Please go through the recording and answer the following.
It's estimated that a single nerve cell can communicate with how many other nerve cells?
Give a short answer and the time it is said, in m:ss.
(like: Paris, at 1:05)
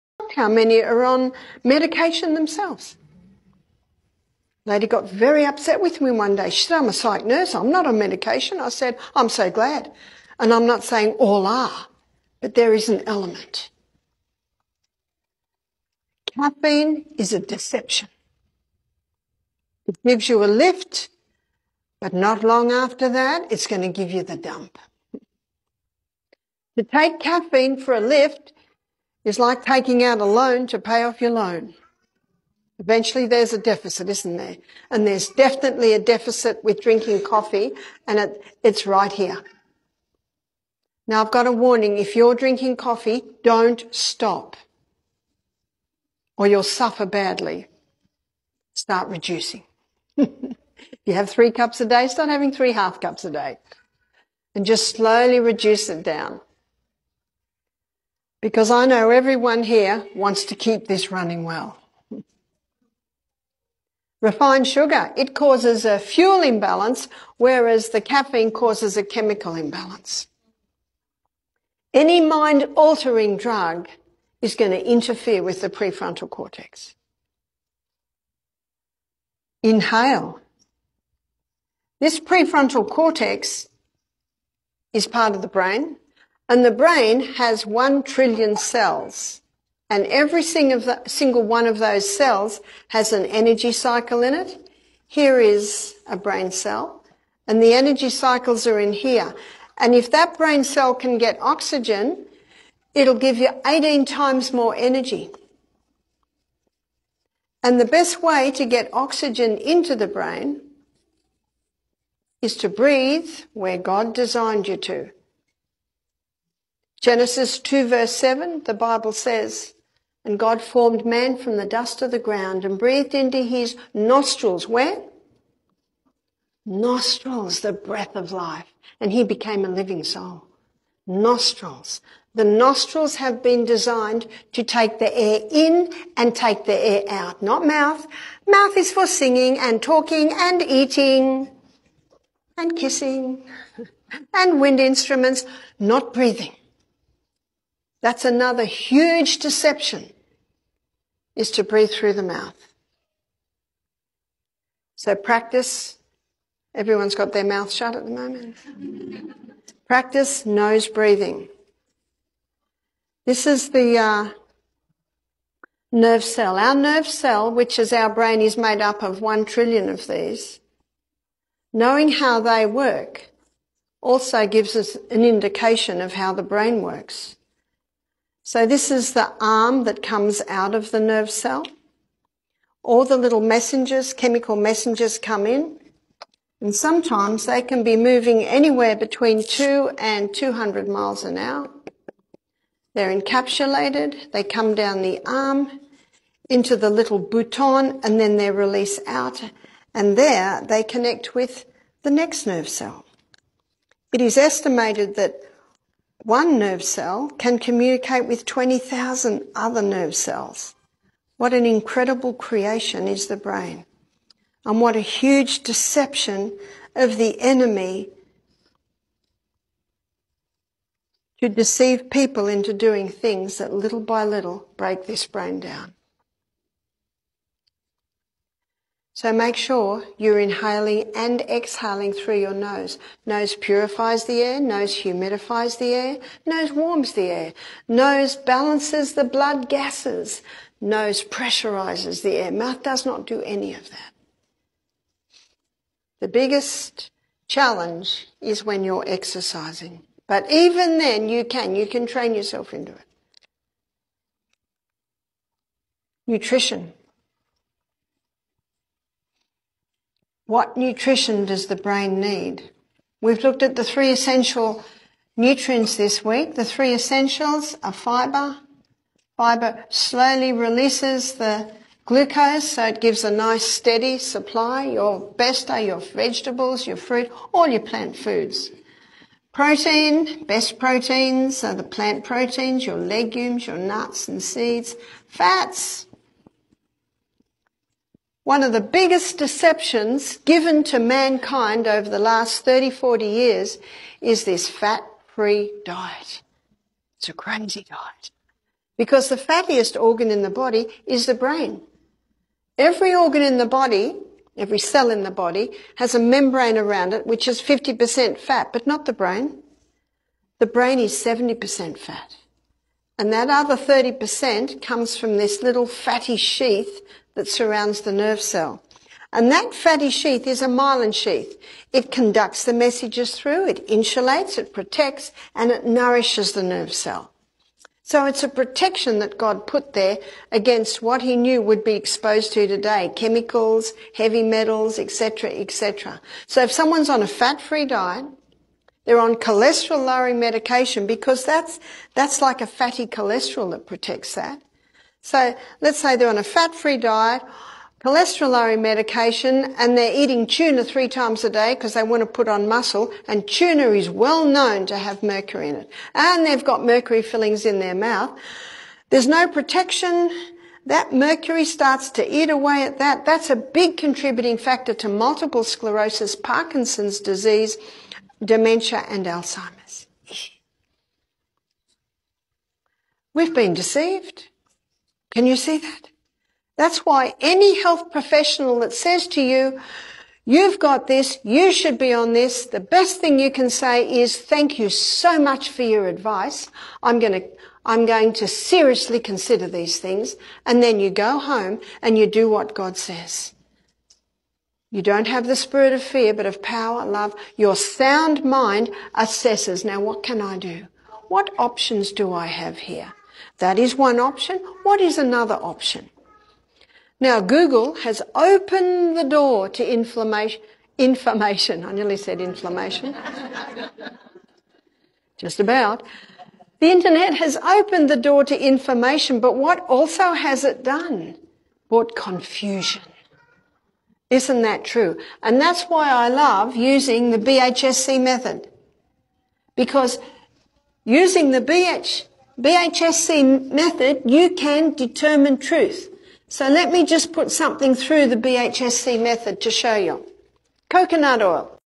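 20,000, at 3:28.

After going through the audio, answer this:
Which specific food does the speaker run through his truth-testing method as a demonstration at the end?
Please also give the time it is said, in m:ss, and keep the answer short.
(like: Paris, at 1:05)
Coconut oil, at 7:20.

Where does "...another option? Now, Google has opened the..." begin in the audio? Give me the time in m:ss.
6:45.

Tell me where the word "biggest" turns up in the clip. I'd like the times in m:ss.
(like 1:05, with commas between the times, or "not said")
4:06, 4:48.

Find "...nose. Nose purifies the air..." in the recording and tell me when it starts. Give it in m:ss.
3:52.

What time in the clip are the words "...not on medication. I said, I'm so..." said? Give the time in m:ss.
0:07.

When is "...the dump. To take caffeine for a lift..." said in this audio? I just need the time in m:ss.
0:24.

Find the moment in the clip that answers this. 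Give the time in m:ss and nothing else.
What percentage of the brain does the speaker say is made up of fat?
5:11.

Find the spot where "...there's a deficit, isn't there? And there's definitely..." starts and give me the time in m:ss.
0:33.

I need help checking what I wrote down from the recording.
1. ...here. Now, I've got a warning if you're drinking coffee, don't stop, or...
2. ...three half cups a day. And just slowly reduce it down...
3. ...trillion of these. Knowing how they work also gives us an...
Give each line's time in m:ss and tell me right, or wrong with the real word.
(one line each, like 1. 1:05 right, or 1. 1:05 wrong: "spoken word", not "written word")
1. 0:39 right
2. 0:52 right
3. 2:49 right.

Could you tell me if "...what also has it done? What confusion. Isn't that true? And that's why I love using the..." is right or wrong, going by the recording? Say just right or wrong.
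right.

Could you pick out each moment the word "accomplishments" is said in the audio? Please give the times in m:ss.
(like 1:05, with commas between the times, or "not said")
not said.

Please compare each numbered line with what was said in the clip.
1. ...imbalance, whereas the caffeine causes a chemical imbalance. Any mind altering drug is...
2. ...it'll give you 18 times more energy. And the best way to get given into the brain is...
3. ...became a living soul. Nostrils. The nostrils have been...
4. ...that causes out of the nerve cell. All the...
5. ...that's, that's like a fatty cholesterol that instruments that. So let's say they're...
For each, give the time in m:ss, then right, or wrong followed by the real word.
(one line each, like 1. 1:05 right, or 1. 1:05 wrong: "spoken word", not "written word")
1. 1:06 right
2. 1:42 wrong: "oxygen", not "given"
3. 2:09 right
4. 2:59 wrong: "comes", not "causes"
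5. 5:41 wrong: "protects", not "instruments".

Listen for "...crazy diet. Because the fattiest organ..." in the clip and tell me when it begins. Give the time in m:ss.
4:57.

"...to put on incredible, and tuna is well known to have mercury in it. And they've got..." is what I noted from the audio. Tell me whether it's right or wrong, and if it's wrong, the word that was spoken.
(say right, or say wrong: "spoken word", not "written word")
wrong: "muscle", not "incredible".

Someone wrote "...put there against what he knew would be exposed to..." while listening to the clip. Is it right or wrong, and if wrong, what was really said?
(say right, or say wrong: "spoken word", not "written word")
right.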